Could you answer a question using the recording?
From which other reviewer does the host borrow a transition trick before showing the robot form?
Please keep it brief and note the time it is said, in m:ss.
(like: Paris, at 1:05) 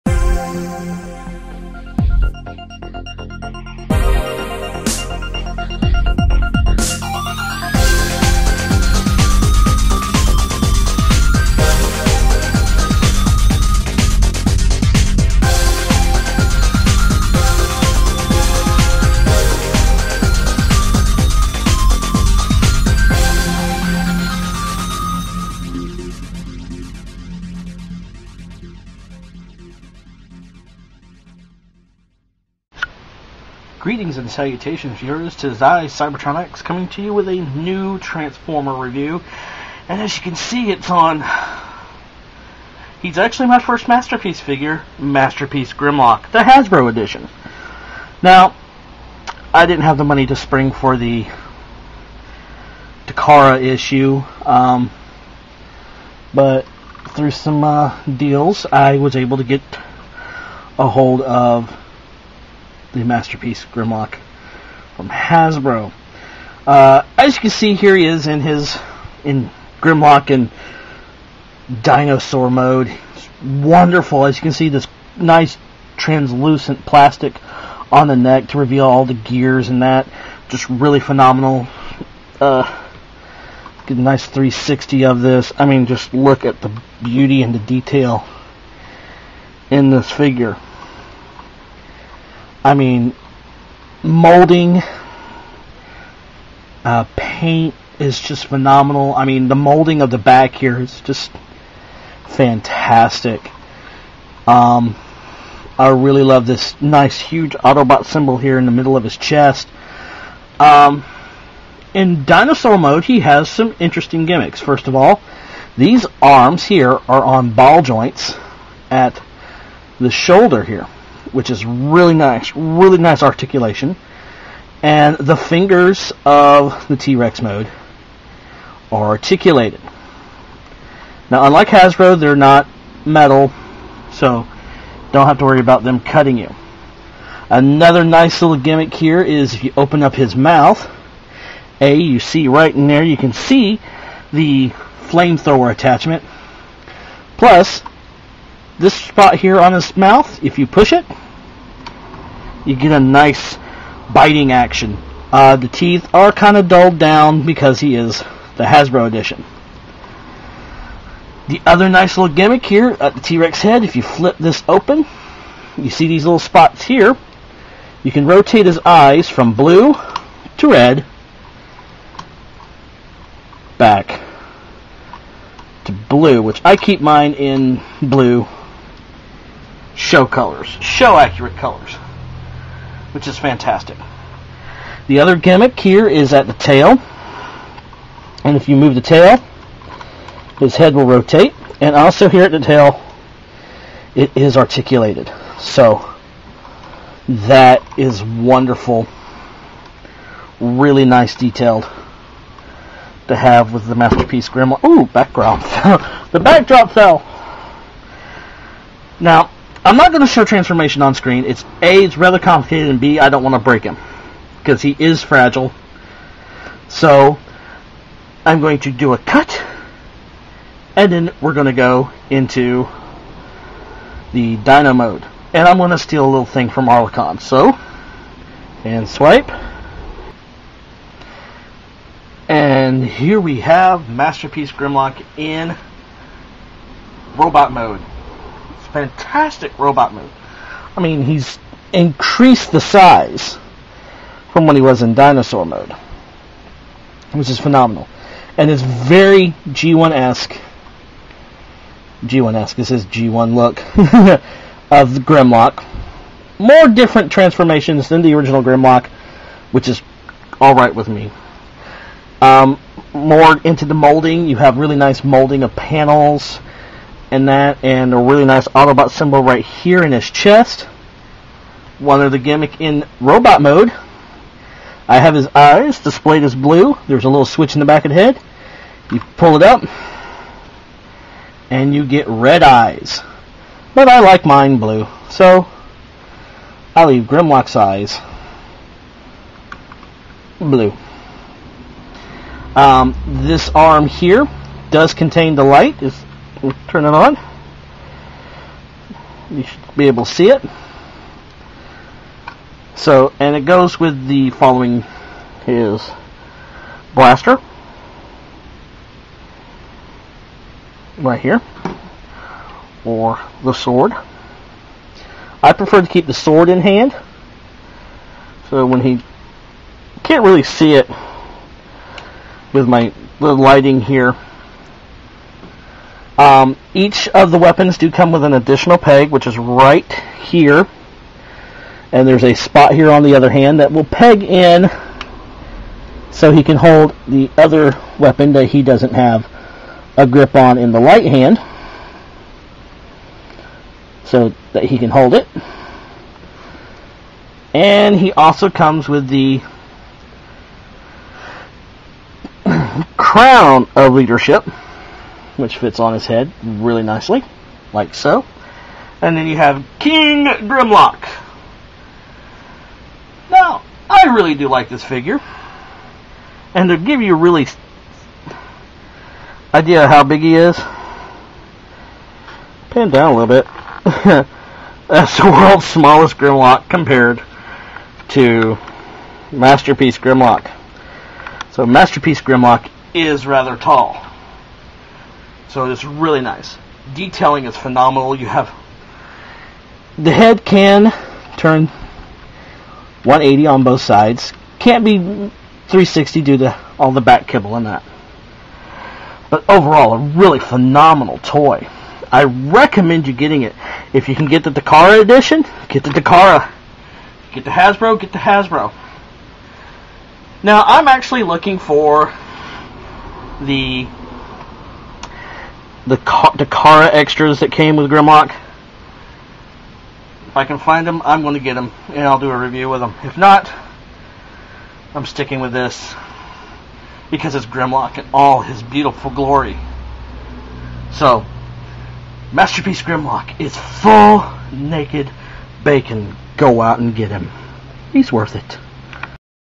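Arlecon, at 3:46.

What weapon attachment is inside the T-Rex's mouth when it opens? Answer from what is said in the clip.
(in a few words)
Flamethrower.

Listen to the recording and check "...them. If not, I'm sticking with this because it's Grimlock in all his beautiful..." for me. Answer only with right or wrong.
right.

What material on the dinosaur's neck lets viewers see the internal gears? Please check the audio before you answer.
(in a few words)
Translucent plastic.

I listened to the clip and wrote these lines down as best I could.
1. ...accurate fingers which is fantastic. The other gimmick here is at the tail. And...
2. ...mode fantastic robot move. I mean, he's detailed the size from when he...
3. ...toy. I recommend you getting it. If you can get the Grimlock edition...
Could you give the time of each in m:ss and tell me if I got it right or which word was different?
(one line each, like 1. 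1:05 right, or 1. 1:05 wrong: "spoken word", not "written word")
1. 3:01 wrong: "colors", not "fingers"
2. 3:57 wrong: "increased", not "detailed"
3. 6:41 wrong: "Dakara", not "Grimlock".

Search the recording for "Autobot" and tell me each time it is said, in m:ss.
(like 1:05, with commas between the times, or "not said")
1:47, 4:28.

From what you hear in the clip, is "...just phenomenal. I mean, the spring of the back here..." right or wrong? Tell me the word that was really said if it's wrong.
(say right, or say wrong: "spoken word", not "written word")
wrong: "molding", not "spring".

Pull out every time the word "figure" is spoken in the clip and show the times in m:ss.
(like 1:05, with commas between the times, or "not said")
0:44, 1:30, 6:05.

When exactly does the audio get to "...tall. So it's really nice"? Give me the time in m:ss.
6:23.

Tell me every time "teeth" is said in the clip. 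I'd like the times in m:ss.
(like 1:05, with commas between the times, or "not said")
2:35.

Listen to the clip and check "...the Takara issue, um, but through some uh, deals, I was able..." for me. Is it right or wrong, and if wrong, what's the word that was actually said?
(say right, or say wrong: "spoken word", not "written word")
right.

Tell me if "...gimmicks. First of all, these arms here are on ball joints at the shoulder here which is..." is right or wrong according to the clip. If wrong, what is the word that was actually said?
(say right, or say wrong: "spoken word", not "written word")
right.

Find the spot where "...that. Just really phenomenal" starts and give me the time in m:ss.
1:19.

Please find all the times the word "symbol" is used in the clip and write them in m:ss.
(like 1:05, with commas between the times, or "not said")
1:48, 4:29.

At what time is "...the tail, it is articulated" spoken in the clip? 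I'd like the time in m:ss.
3:12.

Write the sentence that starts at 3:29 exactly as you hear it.
Now, I'm not going to show transformation on screen.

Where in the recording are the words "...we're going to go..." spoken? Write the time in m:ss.
3:41.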